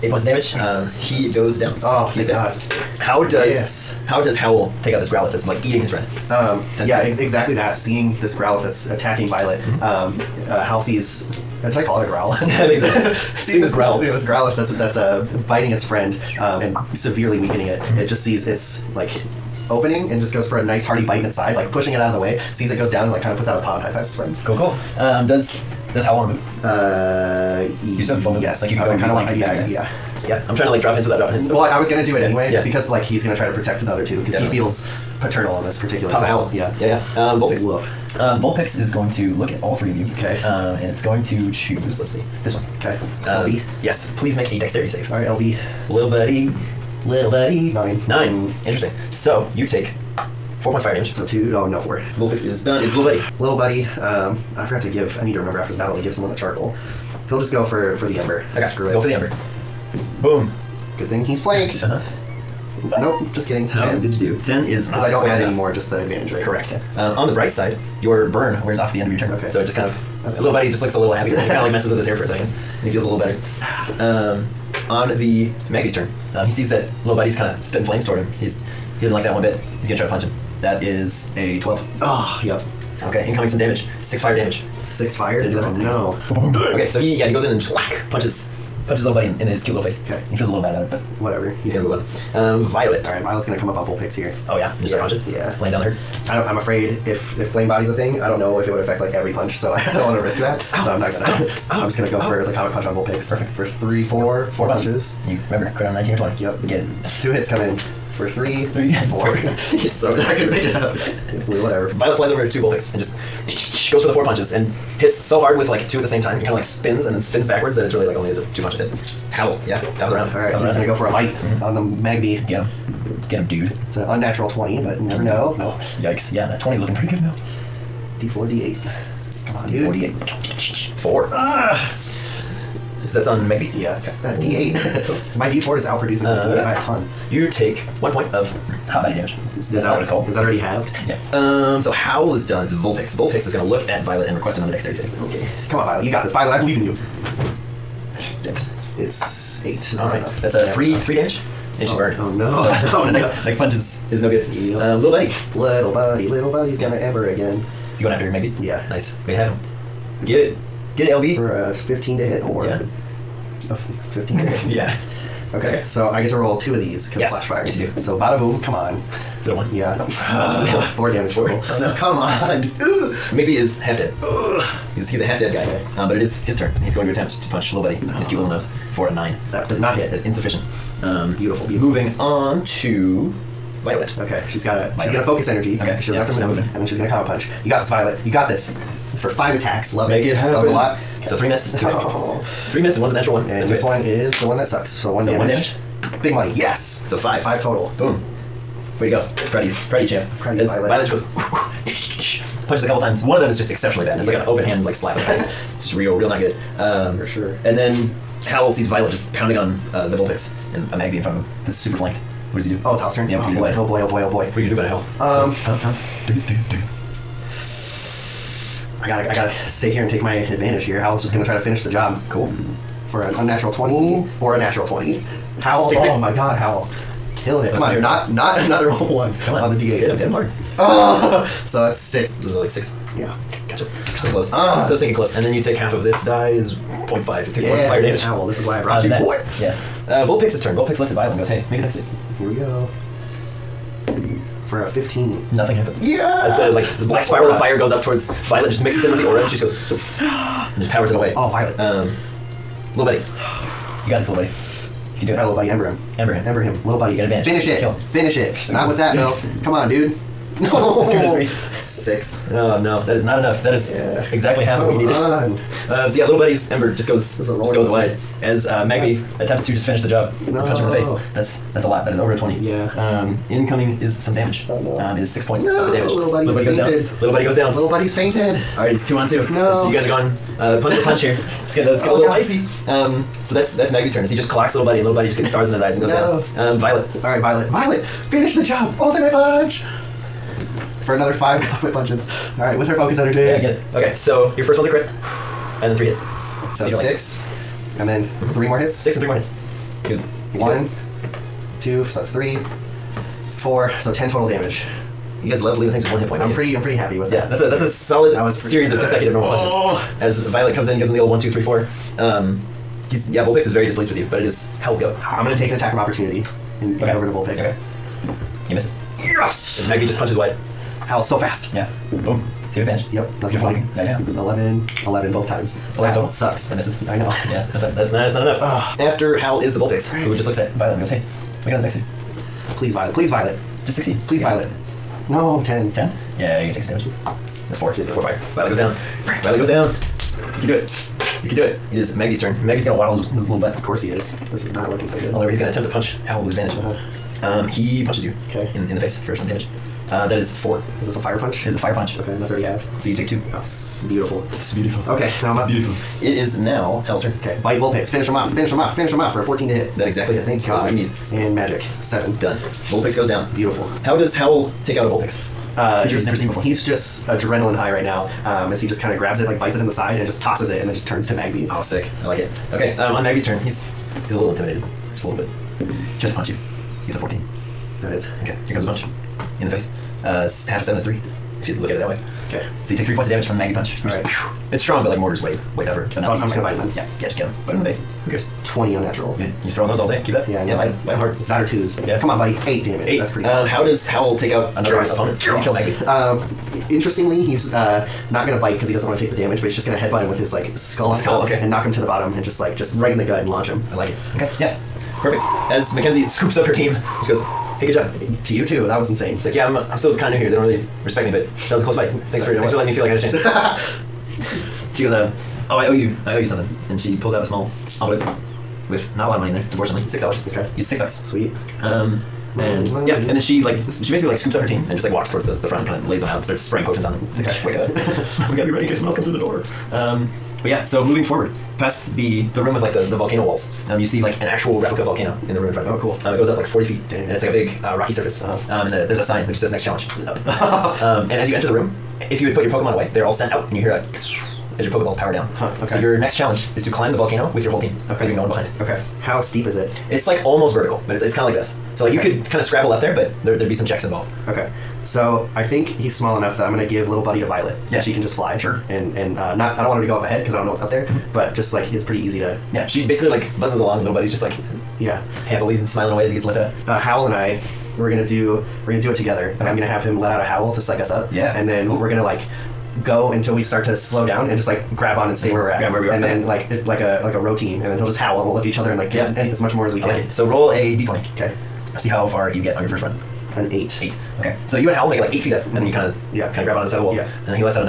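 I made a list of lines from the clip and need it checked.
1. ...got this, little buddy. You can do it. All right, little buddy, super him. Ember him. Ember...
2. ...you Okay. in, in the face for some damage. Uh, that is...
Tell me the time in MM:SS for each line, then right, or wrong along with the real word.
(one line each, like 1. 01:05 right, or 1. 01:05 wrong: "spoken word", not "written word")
1. 04:14 wrong: "ember", not "super"
2. 05:48 right.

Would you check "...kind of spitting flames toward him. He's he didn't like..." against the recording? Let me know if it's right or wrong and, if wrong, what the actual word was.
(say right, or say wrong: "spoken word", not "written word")
right.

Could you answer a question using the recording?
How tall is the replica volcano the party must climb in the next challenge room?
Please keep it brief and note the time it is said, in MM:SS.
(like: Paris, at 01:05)
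40 feet, at 07:16.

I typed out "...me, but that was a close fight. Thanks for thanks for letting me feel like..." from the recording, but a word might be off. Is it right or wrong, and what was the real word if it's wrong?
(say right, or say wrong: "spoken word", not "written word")
right.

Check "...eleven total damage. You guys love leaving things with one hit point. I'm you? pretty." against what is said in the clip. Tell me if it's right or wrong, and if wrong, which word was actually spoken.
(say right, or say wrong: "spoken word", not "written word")
wrong: "ten", not "eleven".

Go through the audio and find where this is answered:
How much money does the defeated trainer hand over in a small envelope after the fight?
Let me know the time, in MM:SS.
07:00.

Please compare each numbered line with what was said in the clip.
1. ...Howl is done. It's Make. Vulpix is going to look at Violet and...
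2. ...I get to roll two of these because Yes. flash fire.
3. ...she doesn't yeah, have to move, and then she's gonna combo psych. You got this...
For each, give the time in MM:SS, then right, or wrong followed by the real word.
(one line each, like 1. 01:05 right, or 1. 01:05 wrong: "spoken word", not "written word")
1. 02:21 wrong: "Vulpix", not "Make"
2. 02:46 right
3. 03:06 wrong: "punch", not "psych".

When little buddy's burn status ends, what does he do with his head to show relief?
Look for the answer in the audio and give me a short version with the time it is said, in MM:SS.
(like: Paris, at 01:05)
messes with his hair, at 01:11.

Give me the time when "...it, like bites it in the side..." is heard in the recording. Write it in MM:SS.
06:09.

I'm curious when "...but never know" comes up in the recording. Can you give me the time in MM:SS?
02:04.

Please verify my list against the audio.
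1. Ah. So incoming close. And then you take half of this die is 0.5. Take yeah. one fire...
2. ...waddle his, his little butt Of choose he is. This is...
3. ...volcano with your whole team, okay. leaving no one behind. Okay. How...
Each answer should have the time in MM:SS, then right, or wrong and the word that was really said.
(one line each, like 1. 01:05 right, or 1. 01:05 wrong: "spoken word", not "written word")
1. 03:54 wrong: "stinking", not "incoming"
2. 05:42 wrong: "course", not "choose"
3. 07:27 right.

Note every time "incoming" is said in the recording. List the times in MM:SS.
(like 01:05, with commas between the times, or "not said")
01:23, 04:33.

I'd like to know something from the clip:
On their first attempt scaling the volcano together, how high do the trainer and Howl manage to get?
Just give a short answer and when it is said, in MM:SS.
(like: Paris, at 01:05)
8 feet, at 08:05.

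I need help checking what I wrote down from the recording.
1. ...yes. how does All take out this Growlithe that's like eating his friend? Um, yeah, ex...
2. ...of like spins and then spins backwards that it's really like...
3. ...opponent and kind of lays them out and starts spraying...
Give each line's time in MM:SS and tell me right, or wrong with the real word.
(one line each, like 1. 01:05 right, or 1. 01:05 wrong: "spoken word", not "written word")
1. 00:03 wrong: "Howl", not "All"
2. 01:56 right
3. 07:05 wrong: "front", not "opponent".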